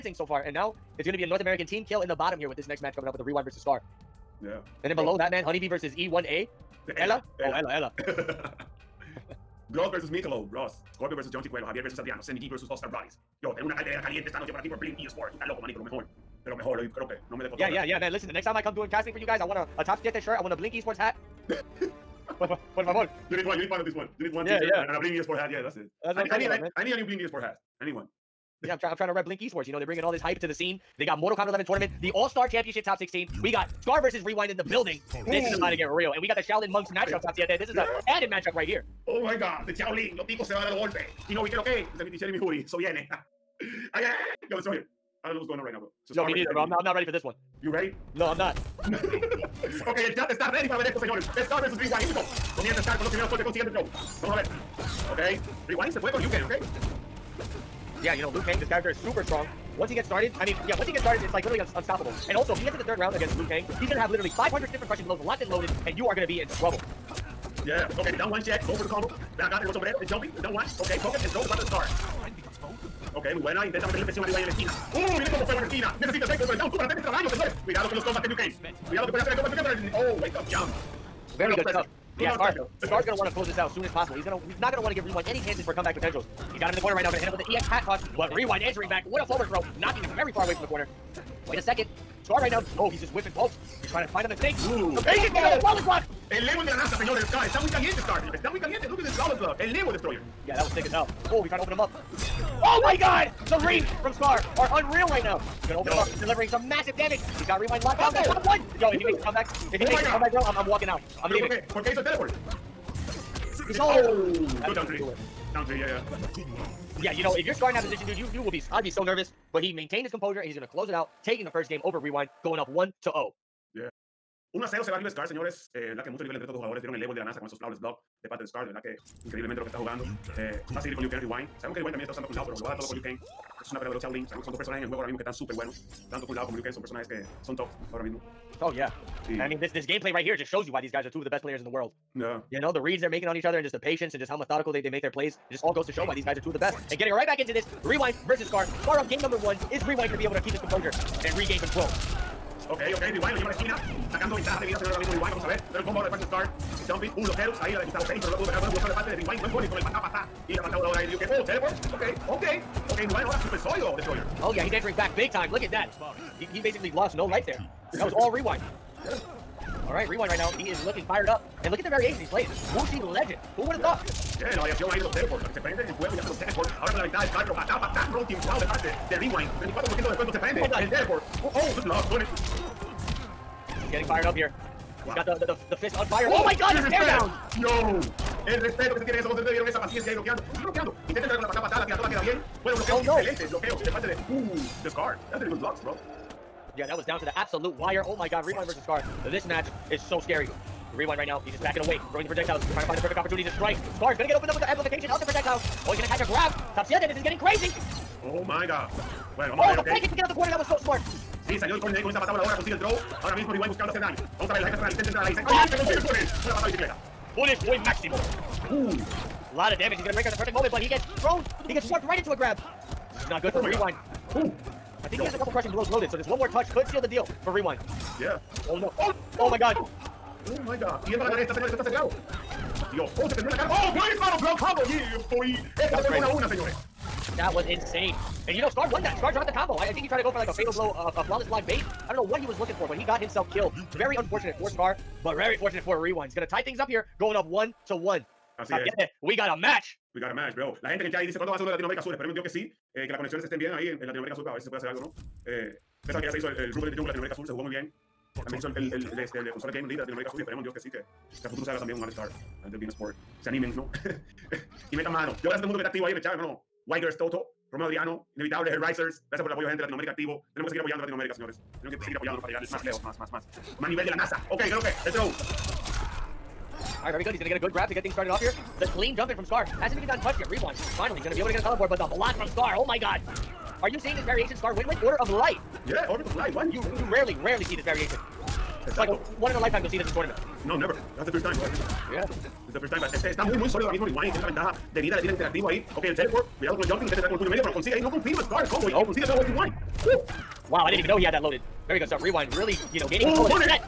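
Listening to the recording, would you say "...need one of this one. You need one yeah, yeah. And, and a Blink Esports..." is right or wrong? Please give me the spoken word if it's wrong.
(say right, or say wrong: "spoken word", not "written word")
right.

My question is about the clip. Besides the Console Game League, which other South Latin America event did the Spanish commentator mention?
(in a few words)
Rumble in the Jungle.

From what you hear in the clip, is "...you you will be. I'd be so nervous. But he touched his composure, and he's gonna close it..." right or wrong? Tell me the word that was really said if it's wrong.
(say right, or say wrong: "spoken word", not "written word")
wrong: "maintained", not "touched".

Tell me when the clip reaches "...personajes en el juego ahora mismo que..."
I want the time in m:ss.
2:14.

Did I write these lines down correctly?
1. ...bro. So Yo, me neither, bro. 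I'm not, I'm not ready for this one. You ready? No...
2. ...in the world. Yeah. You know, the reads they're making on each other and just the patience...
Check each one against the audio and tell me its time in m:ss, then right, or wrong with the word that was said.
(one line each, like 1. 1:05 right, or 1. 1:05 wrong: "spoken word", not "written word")
1. 0:45 right
2. 2:21 right.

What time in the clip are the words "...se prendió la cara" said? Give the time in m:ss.
3:53.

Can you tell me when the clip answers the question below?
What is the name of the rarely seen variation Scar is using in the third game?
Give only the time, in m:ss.
4:46.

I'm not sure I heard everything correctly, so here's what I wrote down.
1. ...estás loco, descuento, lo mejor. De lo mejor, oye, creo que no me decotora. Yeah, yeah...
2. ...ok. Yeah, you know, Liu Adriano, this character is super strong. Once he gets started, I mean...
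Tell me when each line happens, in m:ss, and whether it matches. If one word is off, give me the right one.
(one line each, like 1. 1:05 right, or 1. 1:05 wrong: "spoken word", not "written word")
1. 0:15 wrong: "manito", not "descuento"
2. 0:56 wrong: "Kang", not "Adriano".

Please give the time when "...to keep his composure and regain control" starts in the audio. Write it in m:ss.
2:30.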